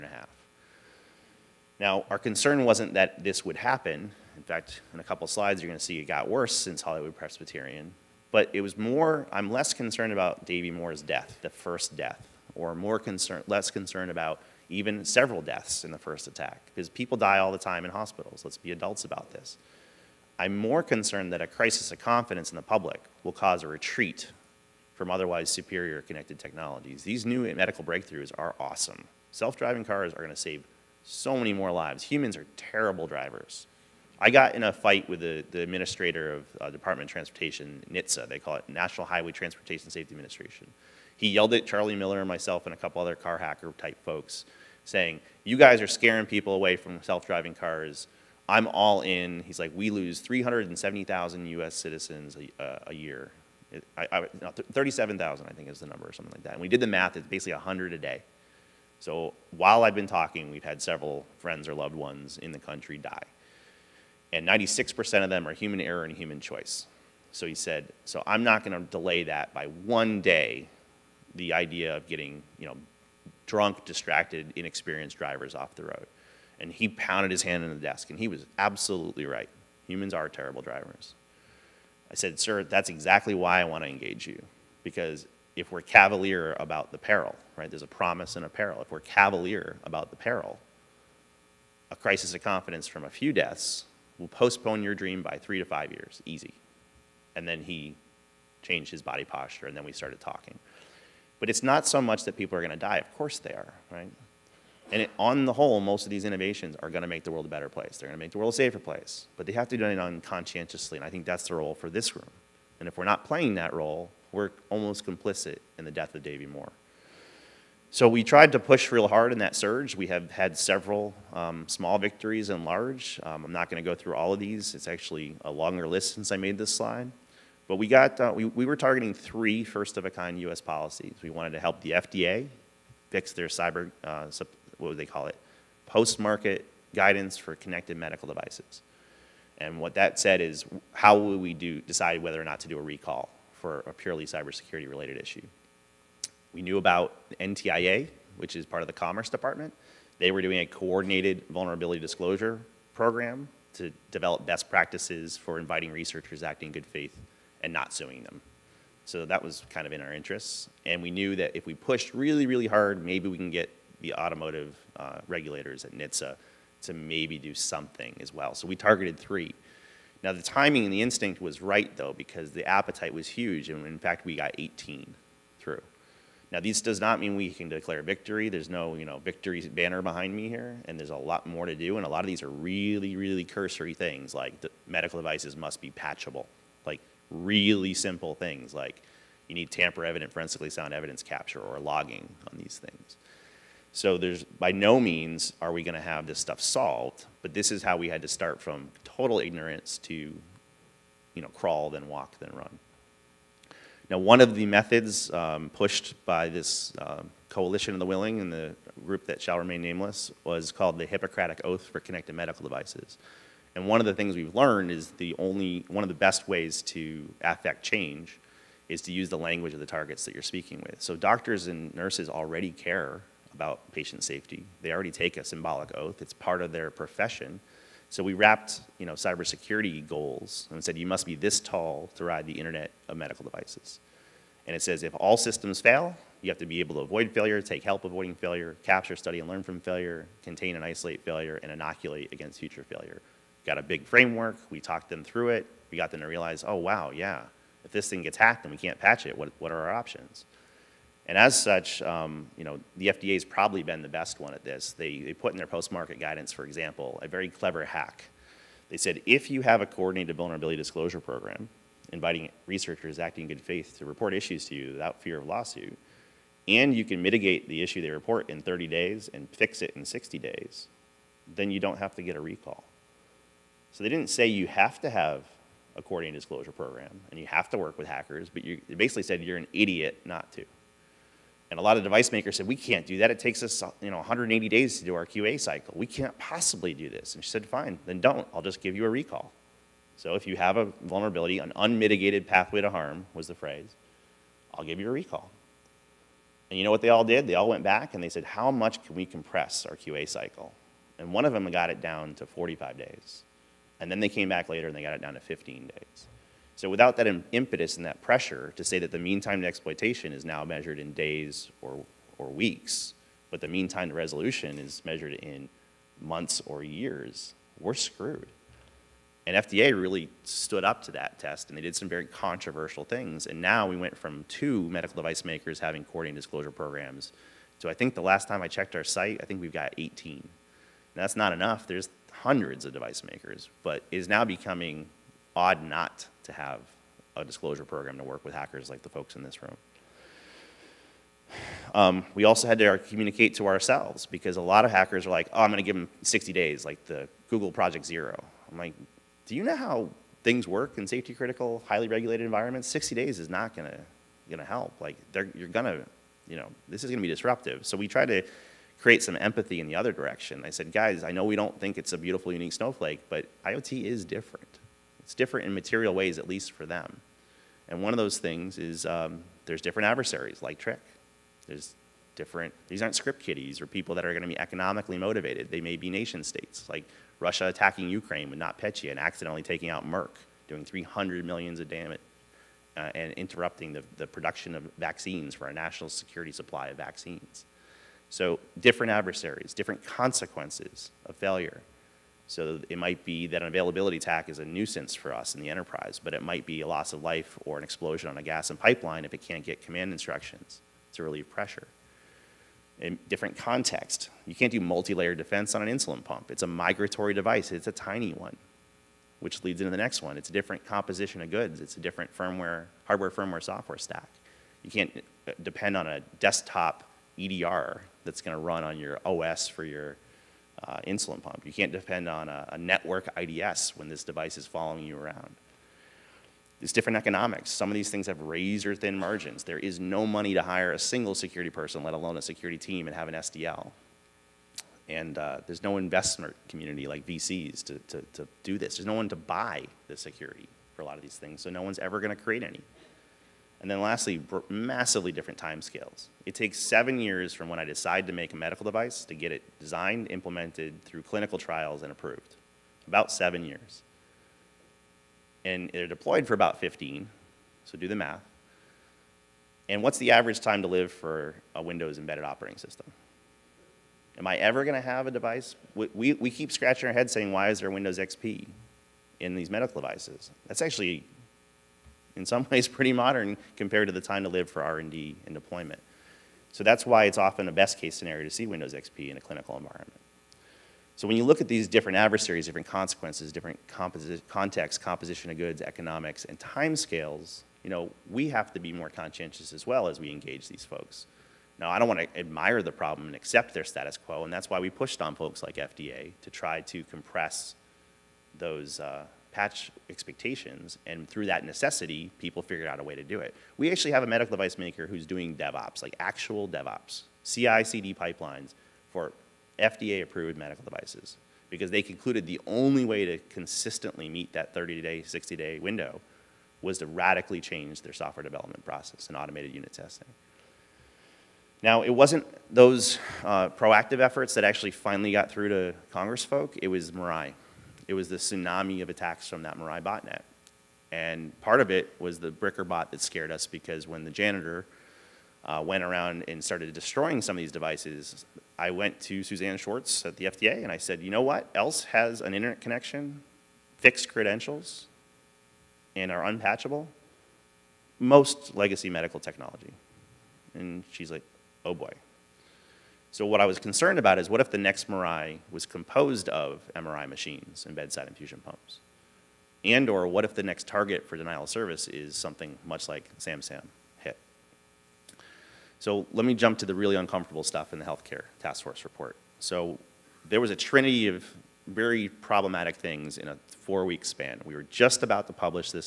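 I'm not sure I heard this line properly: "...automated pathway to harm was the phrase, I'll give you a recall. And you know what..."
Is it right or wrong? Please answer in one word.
wrong.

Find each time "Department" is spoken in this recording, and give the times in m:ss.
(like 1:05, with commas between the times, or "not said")
0:36, 2:29.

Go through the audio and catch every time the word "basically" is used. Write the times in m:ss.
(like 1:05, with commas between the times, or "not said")
0:57, 4:38.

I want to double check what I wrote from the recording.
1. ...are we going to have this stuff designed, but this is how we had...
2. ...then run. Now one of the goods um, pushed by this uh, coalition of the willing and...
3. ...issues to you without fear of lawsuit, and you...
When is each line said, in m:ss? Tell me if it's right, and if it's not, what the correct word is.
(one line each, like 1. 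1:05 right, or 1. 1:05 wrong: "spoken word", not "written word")
1. 3:15 wrong: "solved", not "designed"
2. 3:22 wrong: "methods", not "goods"
3. 4:24 right.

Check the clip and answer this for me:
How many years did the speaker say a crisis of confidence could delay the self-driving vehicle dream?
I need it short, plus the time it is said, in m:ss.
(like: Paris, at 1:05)
3 to 5 years, at 1:35.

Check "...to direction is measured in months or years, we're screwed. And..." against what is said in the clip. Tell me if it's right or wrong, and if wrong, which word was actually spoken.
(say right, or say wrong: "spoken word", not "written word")
wrong: "resolution", not "direction".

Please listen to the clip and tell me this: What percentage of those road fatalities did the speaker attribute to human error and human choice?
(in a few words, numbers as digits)
96%.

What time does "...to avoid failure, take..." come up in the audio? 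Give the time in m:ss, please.
3:56.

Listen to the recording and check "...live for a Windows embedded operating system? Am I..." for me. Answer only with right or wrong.
right.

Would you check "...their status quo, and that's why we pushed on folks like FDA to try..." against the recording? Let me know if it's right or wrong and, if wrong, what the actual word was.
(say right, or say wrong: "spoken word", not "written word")
right.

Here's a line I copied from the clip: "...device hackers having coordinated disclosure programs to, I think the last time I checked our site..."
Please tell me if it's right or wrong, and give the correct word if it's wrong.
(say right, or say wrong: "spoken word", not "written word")
wrong: "makers", not "hackers".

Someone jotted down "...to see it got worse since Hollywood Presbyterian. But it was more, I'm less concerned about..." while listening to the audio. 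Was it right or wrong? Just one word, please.
right.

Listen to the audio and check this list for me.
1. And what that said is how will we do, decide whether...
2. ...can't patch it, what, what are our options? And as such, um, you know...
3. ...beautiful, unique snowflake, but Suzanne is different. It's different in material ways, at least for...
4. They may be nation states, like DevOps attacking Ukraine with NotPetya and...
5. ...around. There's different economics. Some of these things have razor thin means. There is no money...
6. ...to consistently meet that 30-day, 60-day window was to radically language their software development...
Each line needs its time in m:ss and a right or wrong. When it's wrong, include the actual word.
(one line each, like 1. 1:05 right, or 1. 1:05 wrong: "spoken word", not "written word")
1. 2:19 right
2. 4:08 right
3. 6:02 wrong: "IoT", not "Suzanne"
4. 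6:15 wrong: "Russia", not "DevOps"
5. 7:05 wrong: "margins", not "means"
6. 8:33 wrong: "change", not "language".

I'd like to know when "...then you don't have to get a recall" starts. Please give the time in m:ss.
4:31.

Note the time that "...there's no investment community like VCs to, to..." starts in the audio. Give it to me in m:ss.
7:15.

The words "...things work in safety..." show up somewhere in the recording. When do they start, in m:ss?
5:50.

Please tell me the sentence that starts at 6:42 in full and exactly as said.
In different context, you can't do multi-layer defense on an insulin pump.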